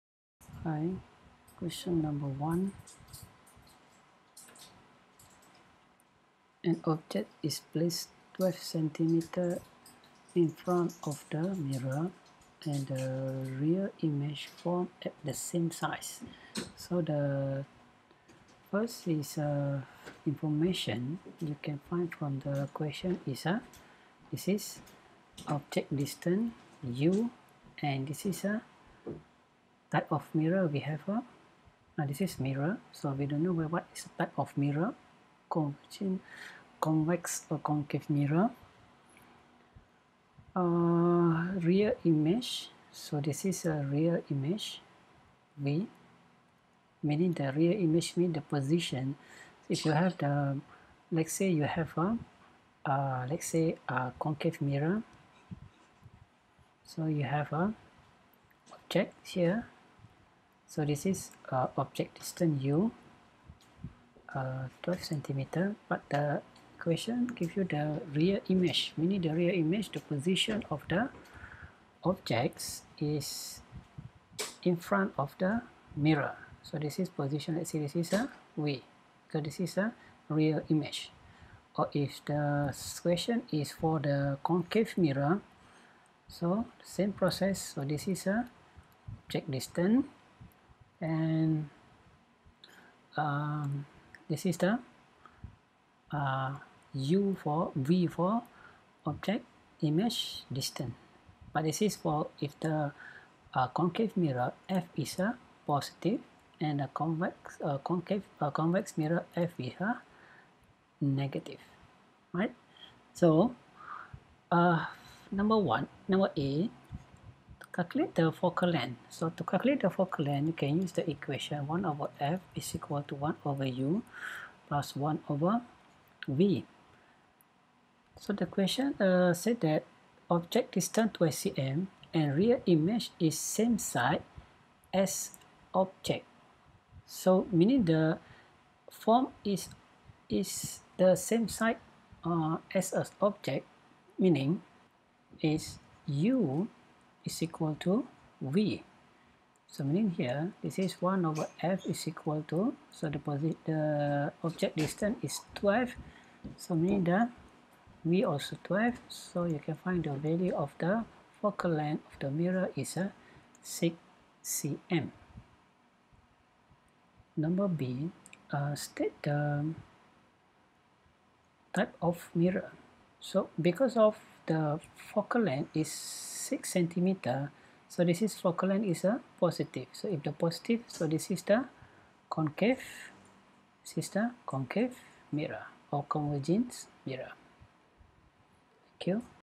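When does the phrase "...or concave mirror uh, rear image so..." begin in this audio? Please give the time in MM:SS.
00:37.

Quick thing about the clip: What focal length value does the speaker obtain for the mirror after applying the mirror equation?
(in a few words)
6 cm.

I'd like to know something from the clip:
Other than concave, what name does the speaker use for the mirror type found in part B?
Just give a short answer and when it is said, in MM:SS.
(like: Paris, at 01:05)
convergent mirror, at 03:06.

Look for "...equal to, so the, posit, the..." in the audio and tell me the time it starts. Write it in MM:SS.
02:32.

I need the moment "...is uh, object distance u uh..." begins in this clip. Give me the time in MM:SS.
01:01.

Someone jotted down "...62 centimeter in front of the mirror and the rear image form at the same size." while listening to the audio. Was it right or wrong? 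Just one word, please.
wrong.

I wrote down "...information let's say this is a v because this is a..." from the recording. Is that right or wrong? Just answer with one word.
wrong.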